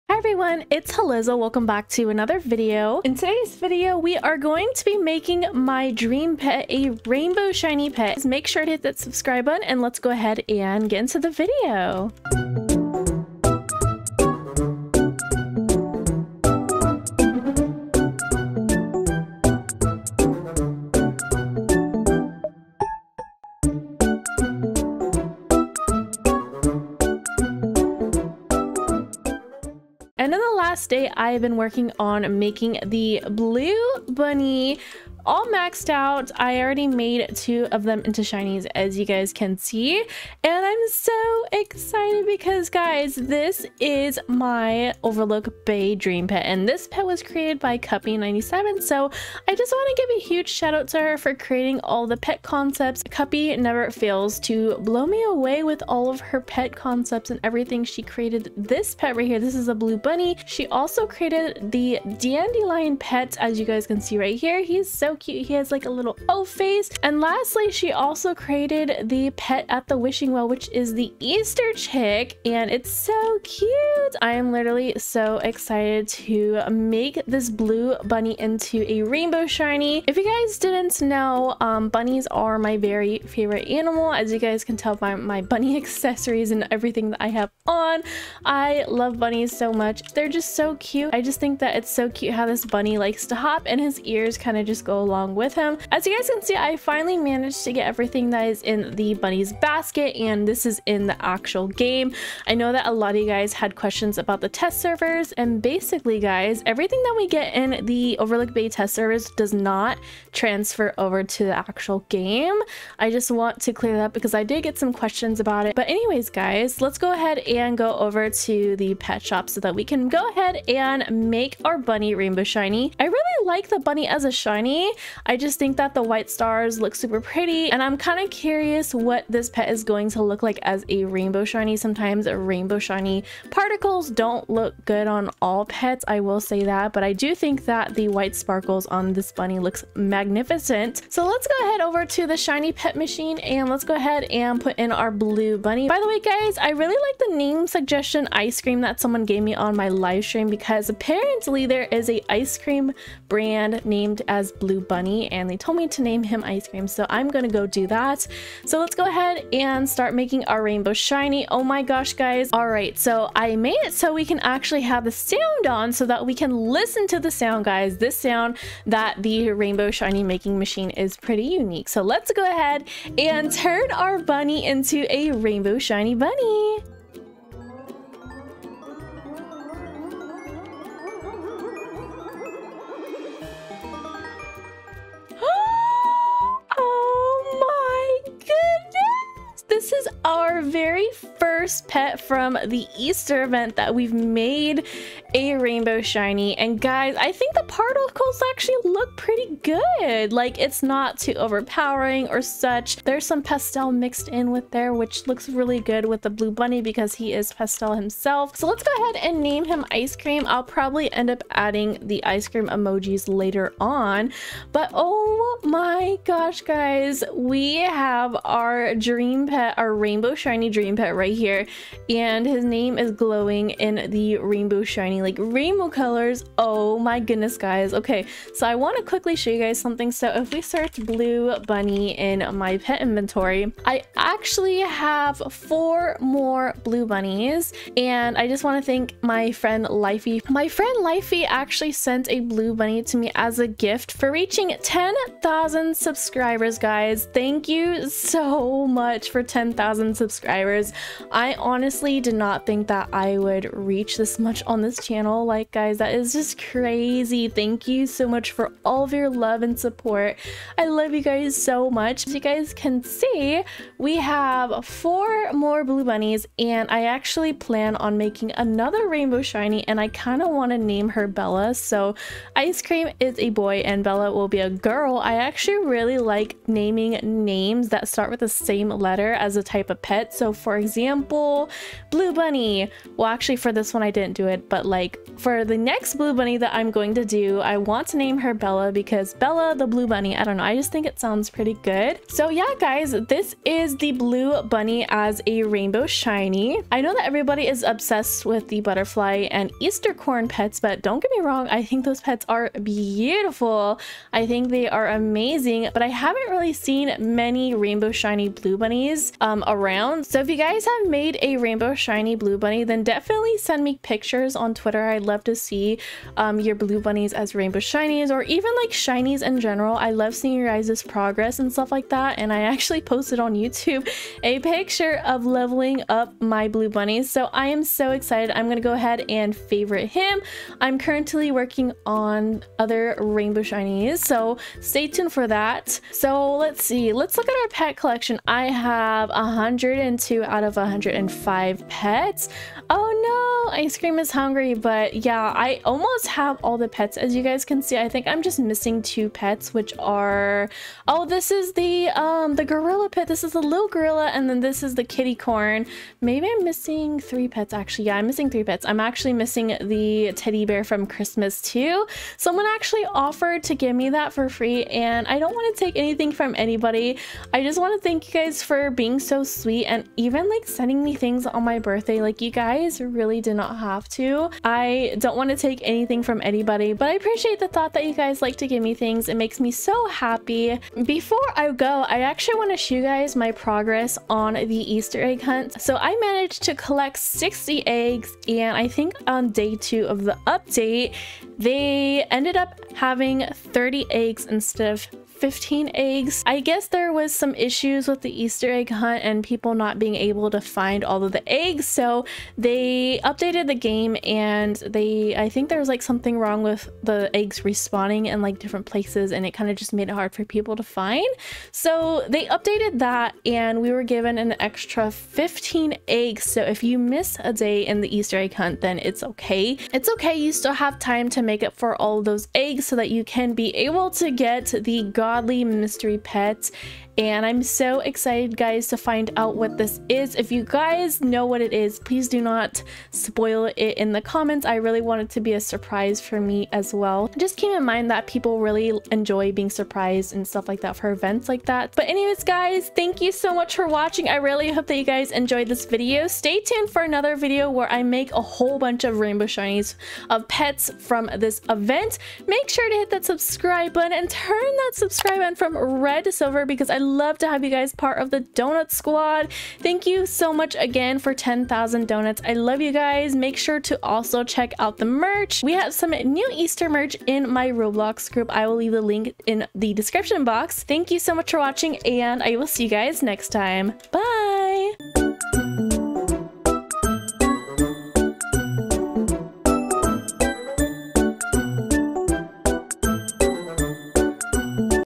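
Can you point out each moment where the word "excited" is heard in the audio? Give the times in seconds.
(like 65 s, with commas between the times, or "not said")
41 s, 75 s, 328 s, 427 s.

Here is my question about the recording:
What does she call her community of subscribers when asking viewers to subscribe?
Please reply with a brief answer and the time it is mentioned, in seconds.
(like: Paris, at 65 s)
donut squad, at 458 s.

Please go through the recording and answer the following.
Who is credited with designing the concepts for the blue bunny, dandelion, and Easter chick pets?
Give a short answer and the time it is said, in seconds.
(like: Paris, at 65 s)
Cuppi97, at 47 s.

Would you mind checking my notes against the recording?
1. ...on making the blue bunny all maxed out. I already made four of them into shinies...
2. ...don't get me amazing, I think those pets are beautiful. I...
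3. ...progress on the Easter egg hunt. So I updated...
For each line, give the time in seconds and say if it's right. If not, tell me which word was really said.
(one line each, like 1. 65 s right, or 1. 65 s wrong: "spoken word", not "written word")
1. 31 s wrong: "two", not "four"
2. 301 s wrong: "wrong", not "amazing"
3. 383 s wrong: "managed", not "updated".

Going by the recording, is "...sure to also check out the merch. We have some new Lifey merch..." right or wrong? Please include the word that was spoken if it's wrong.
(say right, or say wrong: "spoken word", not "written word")
wrong: "Easter", not "Lifey".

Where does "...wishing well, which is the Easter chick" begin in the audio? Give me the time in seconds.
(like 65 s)
69 s.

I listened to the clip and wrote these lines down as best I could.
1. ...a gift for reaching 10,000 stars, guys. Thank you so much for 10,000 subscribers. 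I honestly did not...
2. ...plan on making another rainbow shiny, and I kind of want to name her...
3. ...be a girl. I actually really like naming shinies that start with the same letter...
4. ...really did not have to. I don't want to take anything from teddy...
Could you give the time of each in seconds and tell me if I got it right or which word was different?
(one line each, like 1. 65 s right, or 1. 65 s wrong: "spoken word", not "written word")
1. 243 s wrong: "subscribers", not "stars"
2. 267 s right
3. 274 s wrong: "names", not "shinies"
4. 373 s wrong: "anybody", not "teddy".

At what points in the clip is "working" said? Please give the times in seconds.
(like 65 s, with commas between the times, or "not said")
31 s, 331 s.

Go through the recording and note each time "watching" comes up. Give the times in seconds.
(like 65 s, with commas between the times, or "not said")
443 s, 471 s.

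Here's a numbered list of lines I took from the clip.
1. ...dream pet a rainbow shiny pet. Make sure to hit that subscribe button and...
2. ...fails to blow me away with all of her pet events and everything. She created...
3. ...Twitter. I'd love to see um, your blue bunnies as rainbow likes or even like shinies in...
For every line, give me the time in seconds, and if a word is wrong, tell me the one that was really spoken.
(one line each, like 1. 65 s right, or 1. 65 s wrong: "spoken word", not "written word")
1. 5 s right
2. 53 s wrong: "concepts", not "events"
3. 314 s wrong: "shinies", not "likes".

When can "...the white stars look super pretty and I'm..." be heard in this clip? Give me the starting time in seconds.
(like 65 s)
125 s.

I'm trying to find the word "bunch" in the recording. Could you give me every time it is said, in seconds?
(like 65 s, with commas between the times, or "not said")
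448 s.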